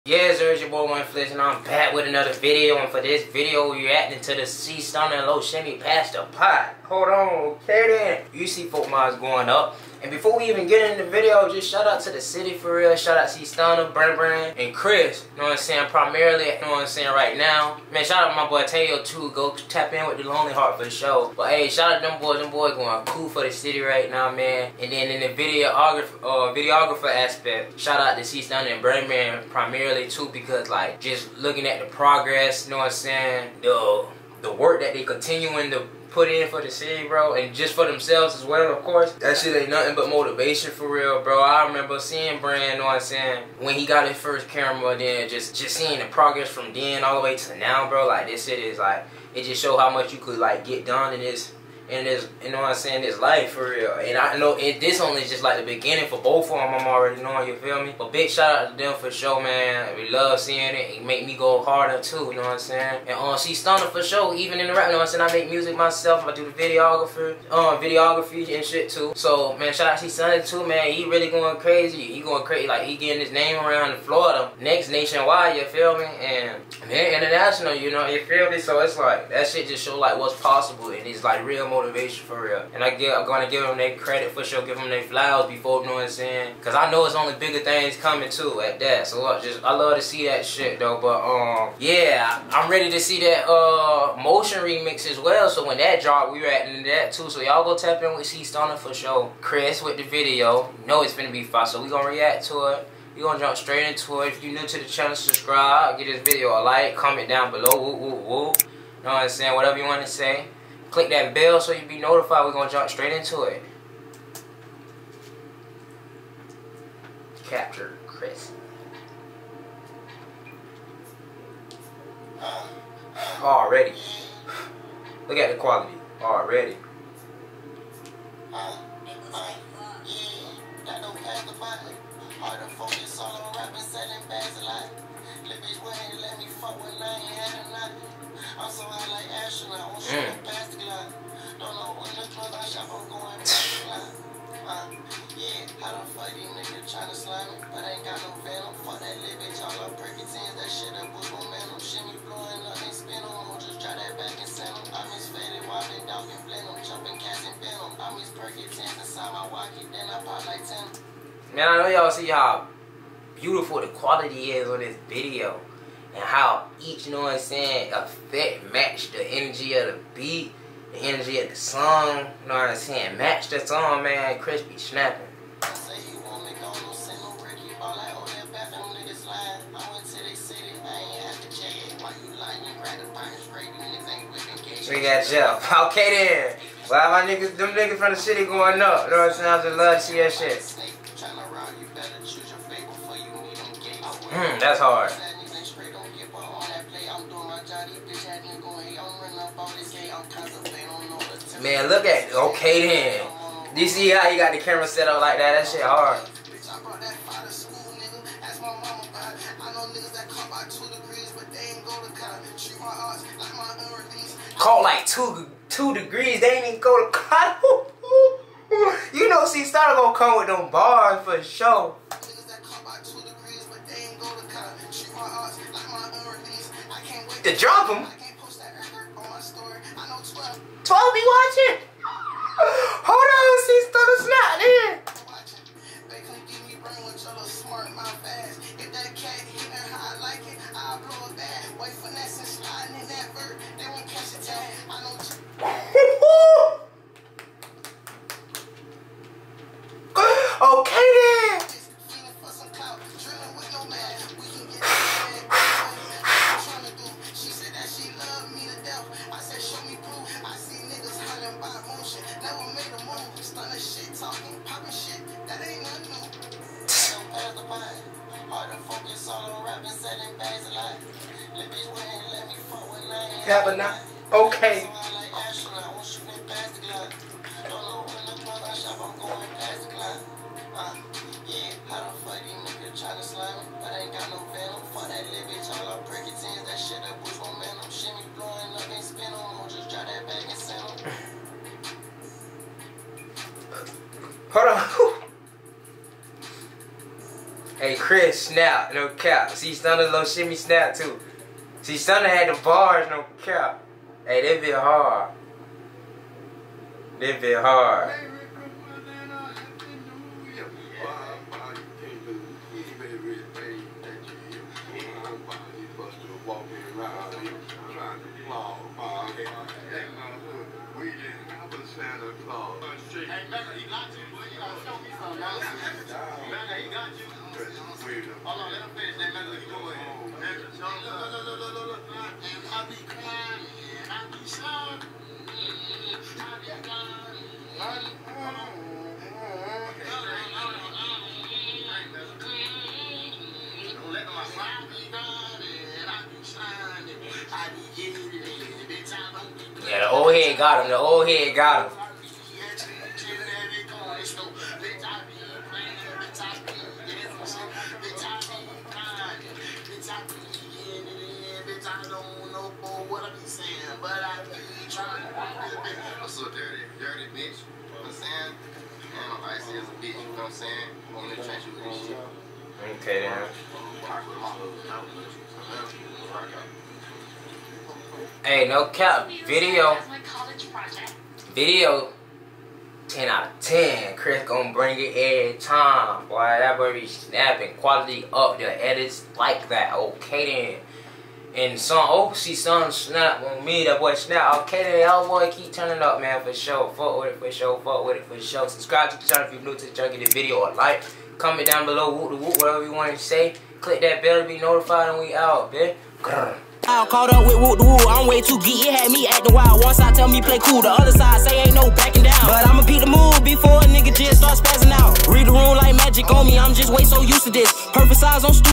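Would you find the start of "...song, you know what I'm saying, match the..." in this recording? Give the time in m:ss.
2:51.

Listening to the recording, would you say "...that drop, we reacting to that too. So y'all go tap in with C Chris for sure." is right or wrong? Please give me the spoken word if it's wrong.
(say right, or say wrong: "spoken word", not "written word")
wrong: "Stunna", not "Chris".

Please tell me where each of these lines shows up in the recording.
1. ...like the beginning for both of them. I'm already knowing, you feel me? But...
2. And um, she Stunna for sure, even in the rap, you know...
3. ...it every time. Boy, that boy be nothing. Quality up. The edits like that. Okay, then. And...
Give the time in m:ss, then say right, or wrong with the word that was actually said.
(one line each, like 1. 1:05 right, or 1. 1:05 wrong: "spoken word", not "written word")
1. 0:55 right
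2. 1:03 right
3. 6:24 wrong: "snapping", not "nothing".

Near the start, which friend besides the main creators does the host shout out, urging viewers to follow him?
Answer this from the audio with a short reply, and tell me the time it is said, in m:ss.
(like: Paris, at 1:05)
Tayo, at 0:18.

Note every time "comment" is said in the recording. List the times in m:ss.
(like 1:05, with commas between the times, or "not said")
1:46, 6:41.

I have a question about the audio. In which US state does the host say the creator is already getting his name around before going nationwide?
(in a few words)
Florida.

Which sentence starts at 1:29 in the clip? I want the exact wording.
So I just, I love to see that shit though.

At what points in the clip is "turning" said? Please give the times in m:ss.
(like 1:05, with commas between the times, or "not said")
6:35.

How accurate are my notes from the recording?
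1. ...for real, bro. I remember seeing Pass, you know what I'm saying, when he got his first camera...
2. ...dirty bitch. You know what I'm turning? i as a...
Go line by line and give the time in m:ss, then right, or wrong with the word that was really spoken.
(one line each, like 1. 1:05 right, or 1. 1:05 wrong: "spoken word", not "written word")
1. 0:40 wrong: "Brand", not "Pass"
2. 6:07 wrong: "saying", not "turning".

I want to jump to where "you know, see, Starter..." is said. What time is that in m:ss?
3:39.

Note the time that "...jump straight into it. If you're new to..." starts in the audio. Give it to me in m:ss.
1:43.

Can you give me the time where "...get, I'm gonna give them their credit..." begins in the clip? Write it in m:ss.
1:22.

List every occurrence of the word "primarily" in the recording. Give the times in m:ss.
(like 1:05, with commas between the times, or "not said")
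0:15, 0:29.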